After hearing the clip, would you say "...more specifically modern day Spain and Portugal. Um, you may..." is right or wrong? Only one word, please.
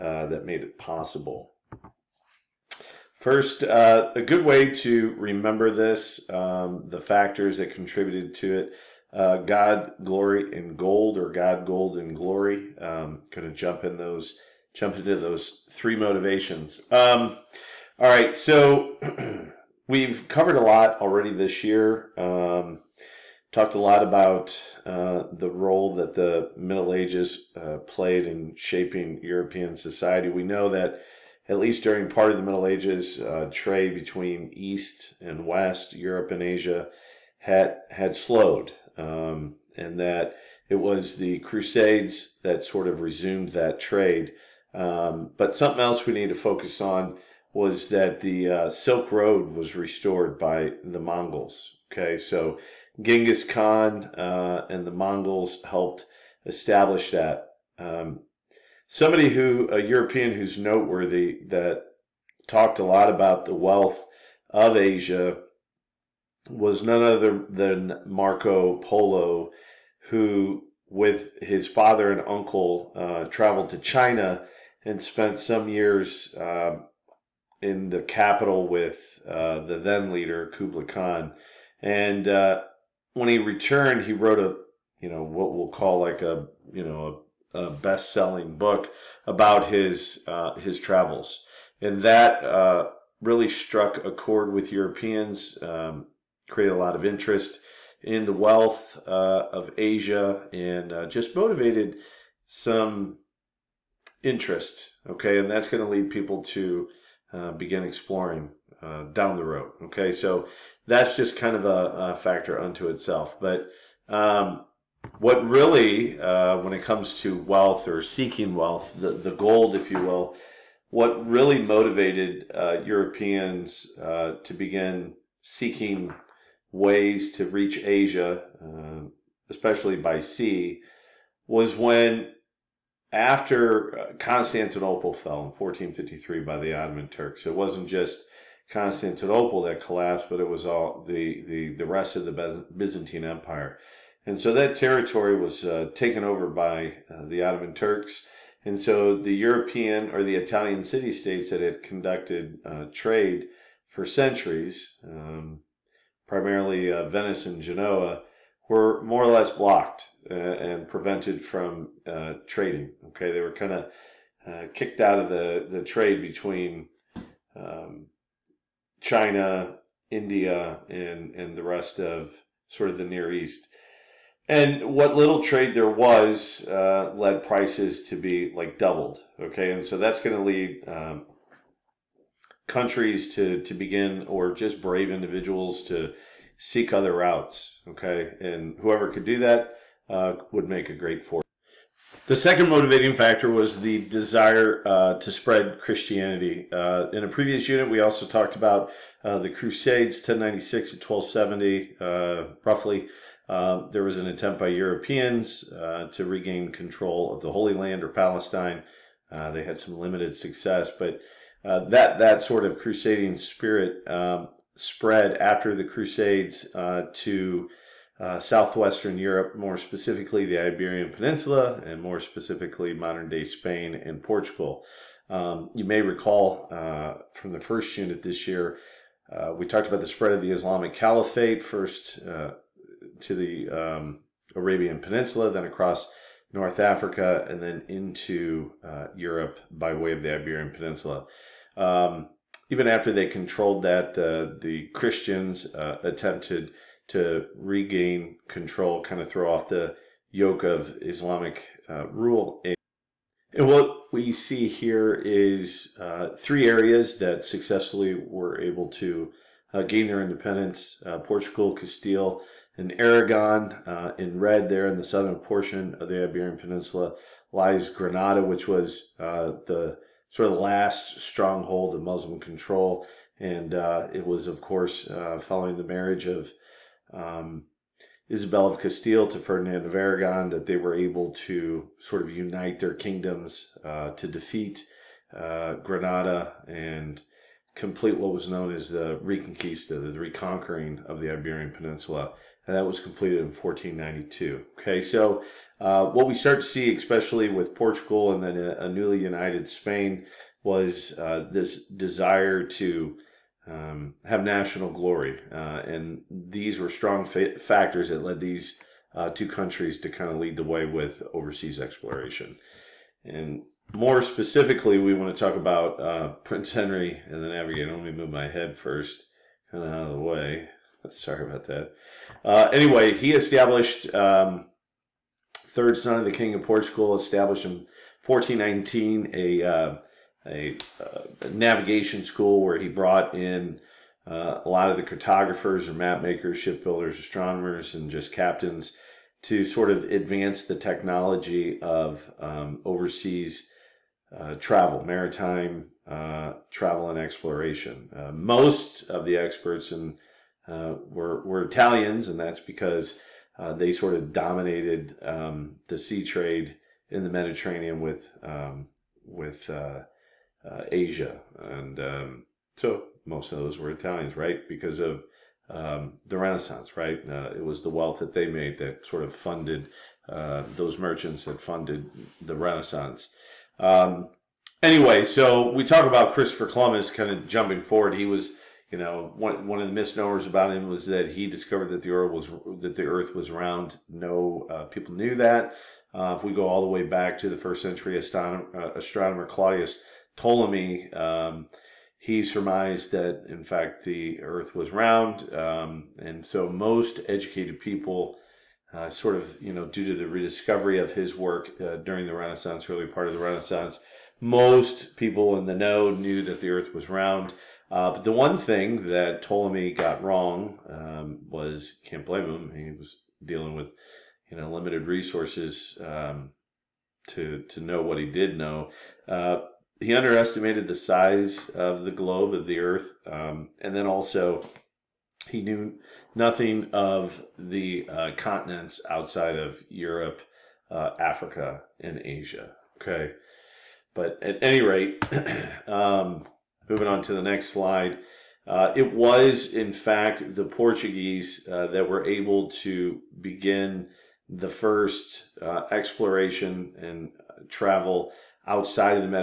right.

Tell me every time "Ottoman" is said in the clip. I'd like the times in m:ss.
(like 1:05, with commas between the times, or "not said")
2:16, 2:27.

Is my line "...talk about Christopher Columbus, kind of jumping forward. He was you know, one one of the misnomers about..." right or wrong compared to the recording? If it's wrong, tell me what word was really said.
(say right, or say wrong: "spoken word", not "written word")
right.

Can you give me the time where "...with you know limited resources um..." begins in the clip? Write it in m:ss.
6:53.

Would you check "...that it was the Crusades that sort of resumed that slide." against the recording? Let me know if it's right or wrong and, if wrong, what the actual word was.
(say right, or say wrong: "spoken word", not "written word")
wrong: "trade", not "slide".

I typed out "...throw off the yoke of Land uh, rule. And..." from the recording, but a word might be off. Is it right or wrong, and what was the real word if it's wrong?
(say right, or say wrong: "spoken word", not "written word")
wrong: "Islamic", not "Land".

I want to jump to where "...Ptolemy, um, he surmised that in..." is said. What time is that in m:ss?
6:30.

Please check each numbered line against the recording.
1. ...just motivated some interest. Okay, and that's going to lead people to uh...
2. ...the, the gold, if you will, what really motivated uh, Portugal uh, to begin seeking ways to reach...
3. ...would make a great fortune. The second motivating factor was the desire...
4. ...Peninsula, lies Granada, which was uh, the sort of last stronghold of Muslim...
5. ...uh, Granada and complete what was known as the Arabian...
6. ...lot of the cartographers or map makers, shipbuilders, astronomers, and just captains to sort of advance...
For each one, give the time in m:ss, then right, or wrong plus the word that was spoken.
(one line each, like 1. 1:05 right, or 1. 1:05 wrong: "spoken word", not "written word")
1. 1:41 right
2. 1:58 wrong: "Europeans", not "Portugal"
3. 3:10 right
4. 4:26 right
5. 4:45 wrong: "Reconquista", not "Arabian"
6. 5:34 right.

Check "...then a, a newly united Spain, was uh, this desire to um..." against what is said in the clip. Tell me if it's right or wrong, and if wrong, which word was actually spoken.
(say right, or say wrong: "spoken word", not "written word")
right.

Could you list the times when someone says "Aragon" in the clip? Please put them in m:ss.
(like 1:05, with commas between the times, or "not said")
4:22, 4:39.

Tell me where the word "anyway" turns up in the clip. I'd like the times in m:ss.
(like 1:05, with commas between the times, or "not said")
5:22, 6:14.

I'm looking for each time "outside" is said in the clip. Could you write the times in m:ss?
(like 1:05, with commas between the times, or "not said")
7:09, 7:28.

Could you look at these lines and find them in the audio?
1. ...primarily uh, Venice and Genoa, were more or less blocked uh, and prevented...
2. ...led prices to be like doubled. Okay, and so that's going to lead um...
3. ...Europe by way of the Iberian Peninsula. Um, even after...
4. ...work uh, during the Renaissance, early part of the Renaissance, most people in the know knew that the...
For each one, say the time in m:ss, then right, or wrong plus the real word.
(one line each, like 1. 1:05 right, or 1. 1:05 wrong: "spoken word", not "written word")
1. 2:36 right
2. 2:57 right
3. 3:59 right
4. 6:41 right.